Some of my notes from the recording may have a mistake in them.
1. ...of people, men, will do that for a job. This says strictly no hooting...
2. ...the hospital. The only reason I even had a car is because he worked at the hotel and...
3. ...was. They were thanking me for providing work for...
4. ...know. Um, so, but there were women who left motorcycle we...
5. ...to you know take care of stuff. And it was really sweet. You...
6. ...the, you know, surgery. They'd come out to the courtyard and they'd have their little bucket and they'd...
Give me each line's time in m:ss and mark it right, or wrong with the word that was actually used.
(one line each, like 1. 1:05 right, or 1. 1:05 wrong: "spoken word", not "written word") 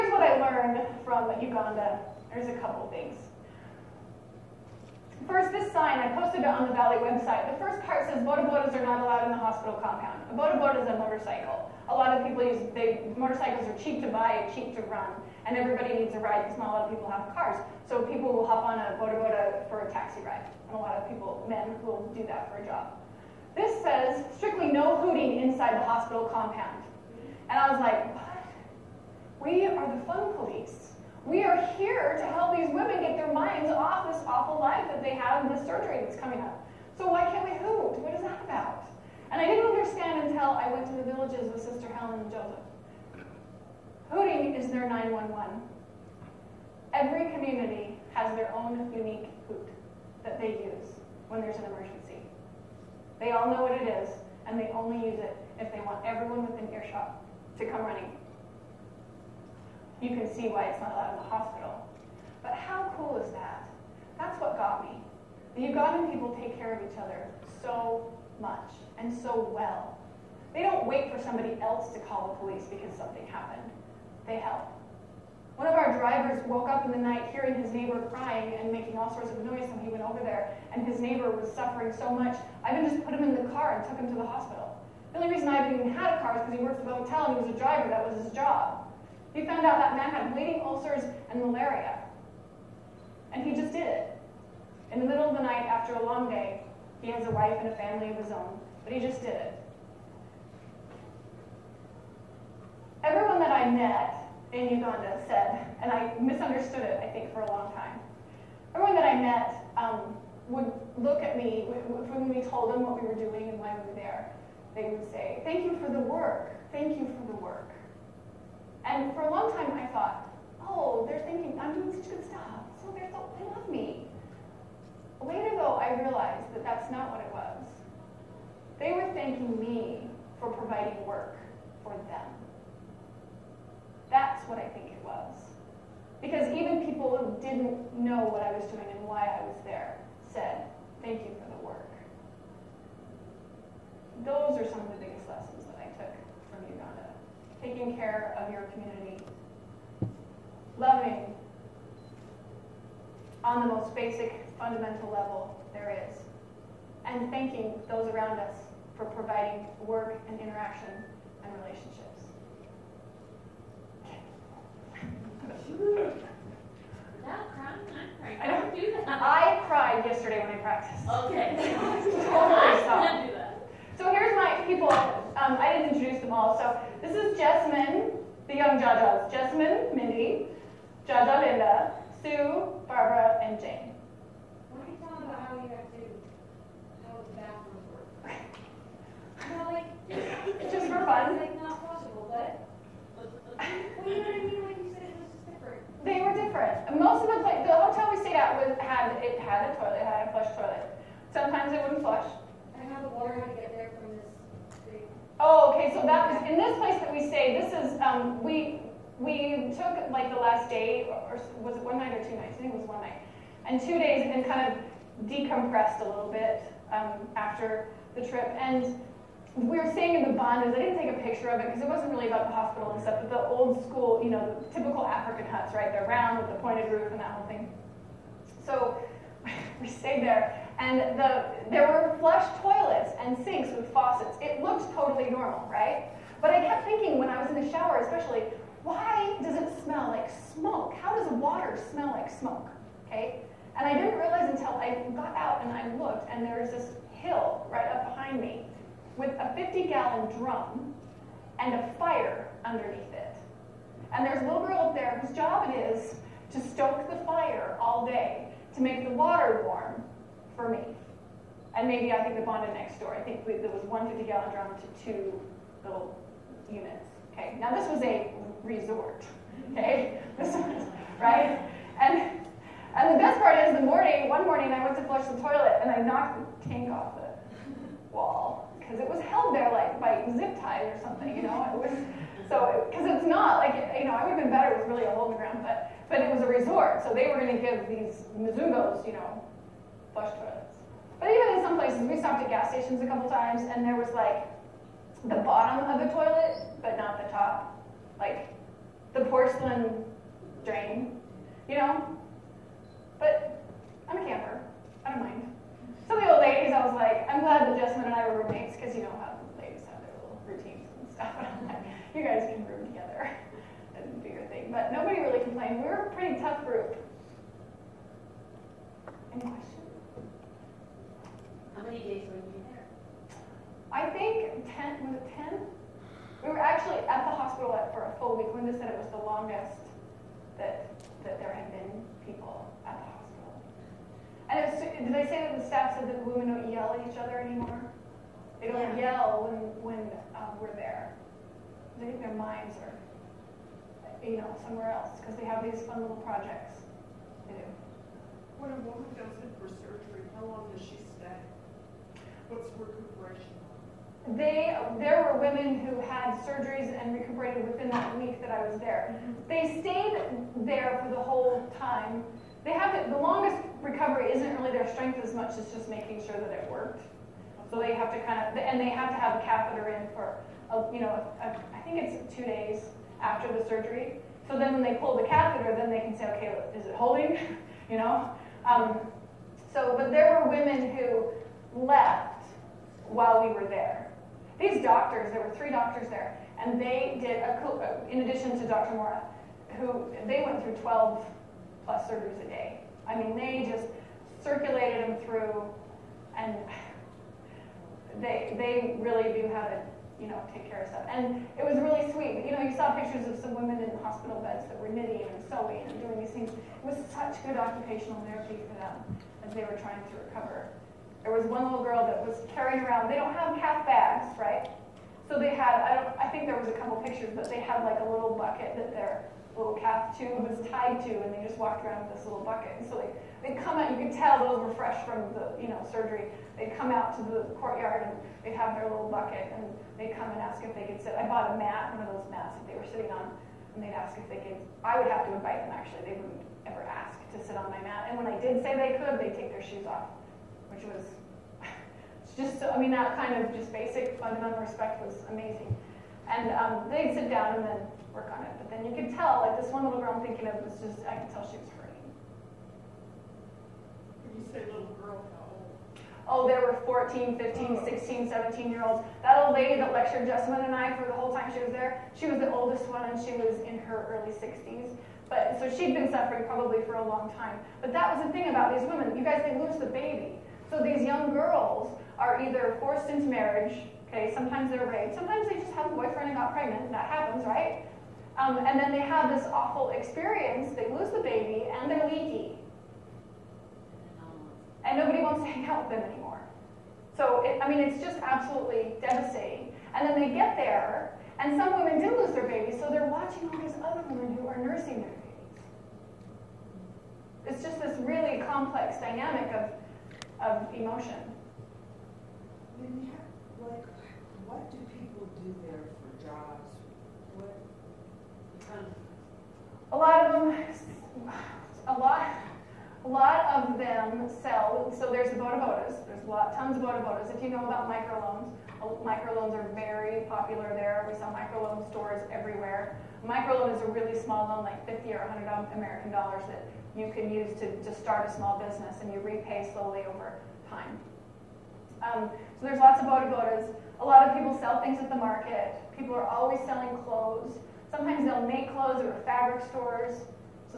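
1. 0:20 right
2. 1:24 right
3. 2:07 right
4. 6:17 wrong: "while", not "motorcycle"
5. 6:39 right
6. 7:05 right.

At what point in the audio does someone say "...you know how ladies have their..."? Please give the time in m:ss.
5:08.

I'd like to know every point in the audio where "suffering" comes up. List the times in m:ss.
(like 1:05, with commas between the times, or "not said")
1:21, 7:46.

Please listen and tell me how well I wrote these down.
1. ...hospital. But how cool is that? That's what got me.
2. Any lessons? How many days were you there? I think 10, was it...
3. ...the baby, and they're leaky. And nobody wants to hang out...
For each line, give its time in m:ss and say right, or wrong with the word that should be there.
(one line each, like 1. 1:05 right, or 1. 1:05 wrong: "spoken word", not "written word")
1. 1:01 right
2. 5:19 wrong: "questions", not "lessons"
3. 8:01 right.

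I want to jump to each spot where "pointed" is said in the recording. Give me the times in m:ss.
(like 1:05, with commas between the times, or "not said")
3:46.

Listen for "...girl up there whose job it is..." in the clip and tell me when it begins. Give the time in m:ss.
4:14.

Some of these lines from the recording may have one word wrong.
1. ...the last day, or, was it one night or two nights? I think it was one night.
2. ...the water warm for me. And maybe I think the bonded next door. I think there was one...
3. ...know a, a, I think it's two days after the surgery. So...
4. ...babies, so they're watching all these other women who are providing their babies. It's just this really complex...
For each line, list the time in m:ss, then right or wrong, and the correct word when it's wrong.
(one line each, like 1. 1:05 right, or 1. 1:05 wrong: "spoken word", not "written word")
1. 3:30 right
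2. 4:19 right
3. 6:10 right
4. 8:12 wrong: "nursing", not "providing".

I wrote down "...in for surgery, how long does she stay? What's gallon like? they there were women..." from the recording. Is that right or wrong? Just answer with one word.
wrong.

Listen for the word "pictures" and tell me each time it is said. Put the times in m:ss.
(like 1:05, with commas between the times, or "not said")
3:41, 6:42, 6:57.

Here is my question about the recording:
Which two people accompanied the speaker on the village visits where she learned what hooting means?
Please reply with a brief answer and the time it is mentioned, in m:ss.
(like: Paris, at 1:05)
Sister Helen and Joseph, at 0:41.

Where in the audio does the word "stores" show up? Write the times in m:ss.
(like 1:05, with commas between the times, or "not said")
8:41, 8:59.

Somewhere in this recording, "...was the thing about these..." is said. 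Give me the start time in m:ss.
7:48.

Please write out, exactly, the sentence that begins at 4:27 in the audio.
Okay, now this was a resort.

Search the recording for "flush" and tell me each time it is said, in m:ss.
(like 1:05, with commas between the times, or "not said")
3:52, 4:35, 4:50.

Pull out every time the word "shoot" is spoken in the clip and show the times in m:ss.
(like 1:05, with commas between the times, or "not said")
not said.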